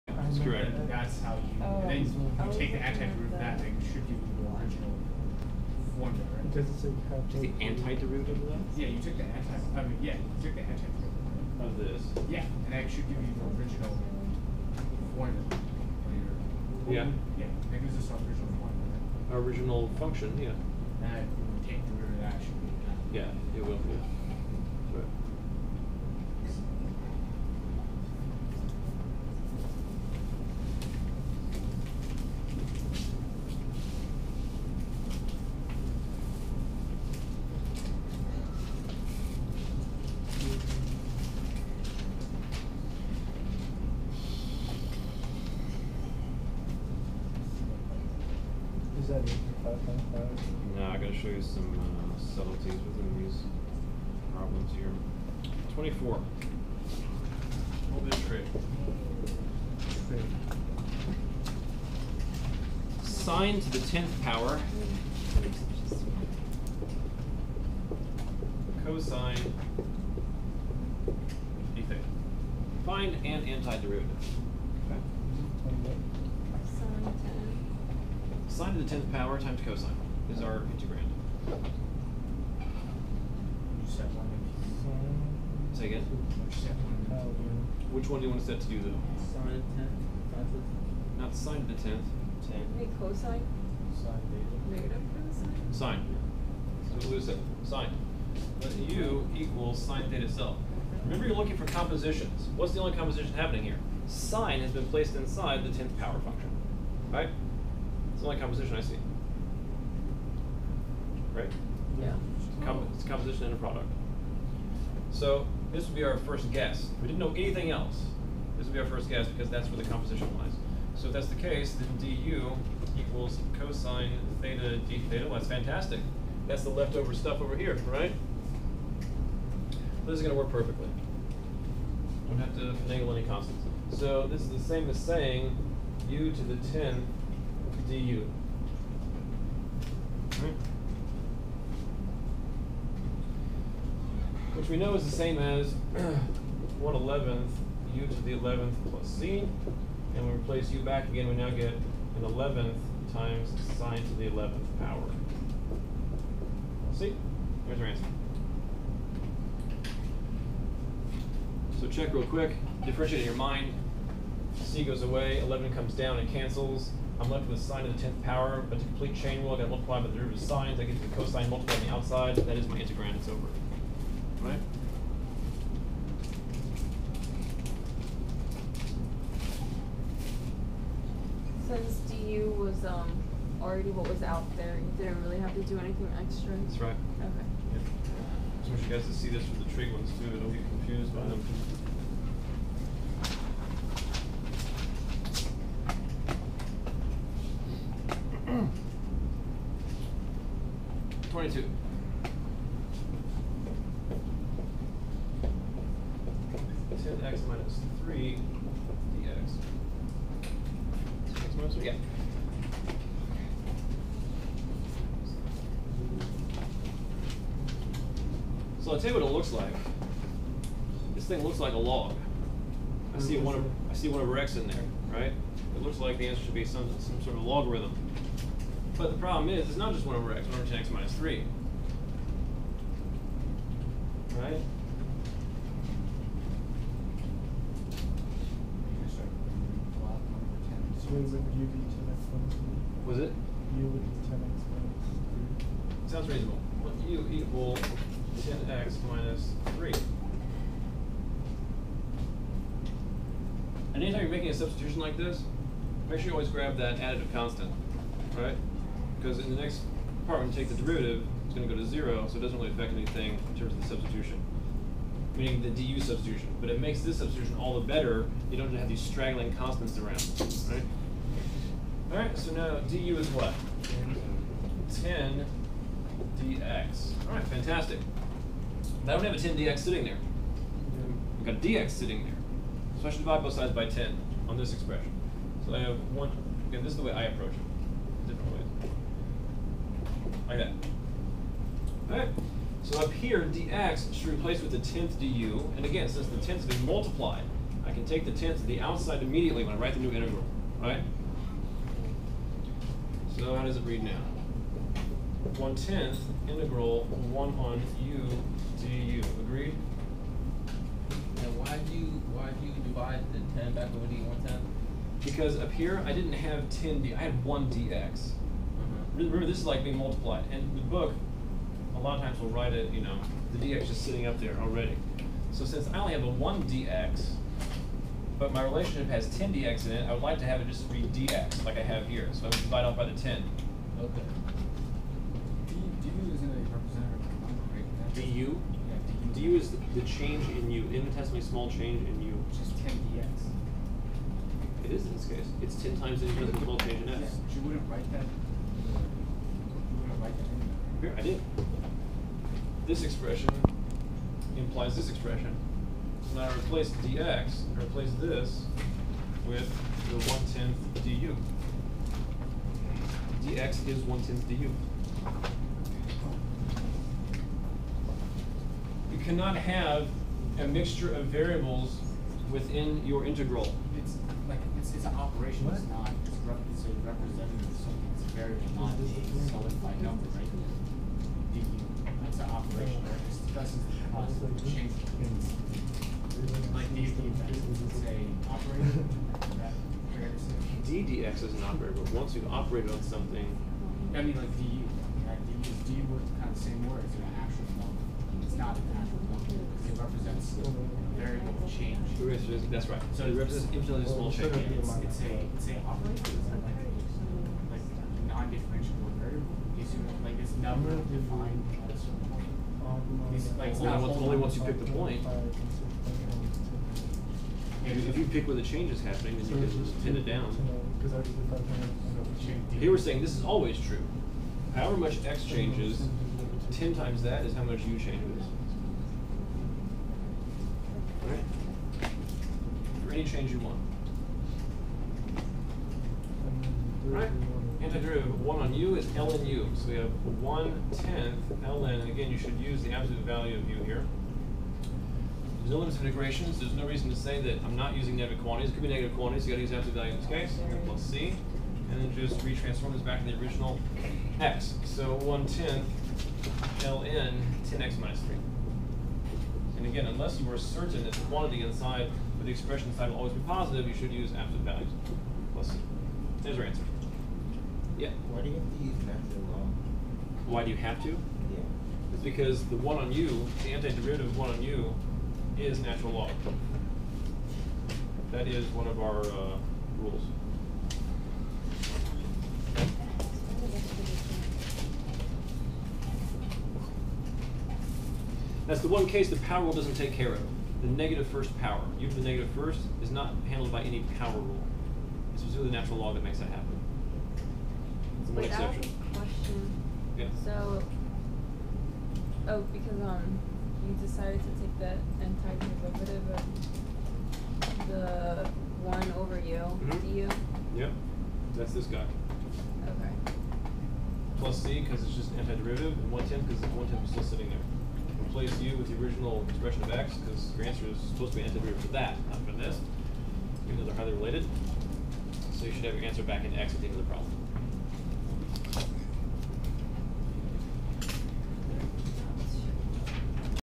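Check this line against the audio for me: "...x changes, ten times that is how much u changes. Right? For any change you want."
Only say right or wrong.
right.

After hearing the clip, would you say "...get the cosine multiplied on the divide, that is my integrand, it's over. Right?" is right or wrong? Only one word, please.
wrong.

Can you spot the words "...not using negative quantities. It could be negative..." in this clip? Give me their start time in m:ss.
7:27.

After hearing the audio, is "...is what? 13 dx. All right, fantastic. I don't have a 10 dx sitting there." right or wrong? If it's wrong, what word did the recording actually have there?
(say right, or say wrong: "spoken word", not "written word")
wrong: "10", not "13".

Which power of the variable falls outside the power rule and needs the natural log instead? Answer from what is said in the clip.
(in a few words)
negative first power.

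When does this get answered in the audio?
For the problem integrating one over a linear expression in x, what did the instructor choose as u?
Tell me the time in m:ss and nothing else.
4:07.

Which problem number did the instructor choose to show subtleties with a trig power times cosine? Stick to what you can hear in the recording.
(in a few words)
24.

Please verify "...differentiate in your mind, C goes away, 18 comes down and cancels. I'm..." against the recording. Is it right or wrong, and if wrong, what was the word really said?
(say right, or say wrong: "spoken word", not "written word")
wrong: "11", not "18".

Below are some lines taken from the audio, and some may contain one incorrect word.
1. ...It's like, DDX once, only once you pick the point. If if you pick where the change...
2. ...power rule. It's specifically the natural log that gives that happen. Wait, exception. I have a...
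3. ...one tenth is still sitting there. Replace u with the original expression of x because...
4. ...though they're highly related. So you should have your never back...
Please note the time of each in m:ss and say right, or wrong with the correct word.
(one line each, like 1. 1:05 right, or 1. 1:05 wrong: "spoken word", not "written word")
1. 6:53 wrong: "Only", not "DDX"
2. 8:14 wrong: "makes", not "gives"
3. 8:36 right
4. 8:43 wrong: "answer", not "never".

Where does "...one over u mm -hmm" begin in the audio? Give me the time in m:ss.
8:28.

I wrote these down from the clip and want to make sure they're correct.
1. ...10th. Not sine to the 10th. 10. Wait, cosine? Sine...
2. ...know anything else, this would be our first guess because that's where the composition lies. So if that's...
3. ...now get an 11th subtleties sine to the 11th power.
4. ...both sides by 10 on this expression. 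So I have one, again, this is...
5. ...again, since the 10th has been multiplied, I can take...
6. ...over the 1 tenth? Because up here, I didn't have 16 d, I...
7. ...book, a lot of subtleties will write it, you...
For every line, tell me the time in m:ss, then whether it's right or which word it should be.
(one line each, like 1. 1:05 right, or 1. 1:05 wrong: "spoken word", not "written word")
1. 1:30 right
2. 1:57 right
3. 2:31 wrong: "times", not "subtleties"
4. 4:43 right
5. 4:55 right
6. 5:13 wrong: "10", not "16"
7. 5:20 wrong: "times", not "subtleties".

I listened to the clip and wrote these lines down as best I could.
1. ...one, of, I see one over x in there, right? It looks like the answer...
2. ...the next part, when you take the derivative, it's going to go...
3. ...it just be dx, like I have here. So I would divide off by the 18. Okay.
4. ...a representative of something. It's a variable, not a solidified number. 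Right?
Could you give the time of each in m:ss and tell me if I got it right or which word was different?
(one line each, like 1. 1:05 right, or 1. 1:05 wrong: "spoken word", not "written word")
1. 3:43 right
2. 4:19 right
3. 5:30 wrong: "10", not "18"
4. 6:16 right.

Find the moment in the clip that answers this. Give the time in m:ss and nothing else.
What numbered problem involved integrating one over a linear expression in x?
3:21.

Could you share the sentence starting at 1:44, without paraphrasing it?
Sine has been placed inside the 10th power function, right?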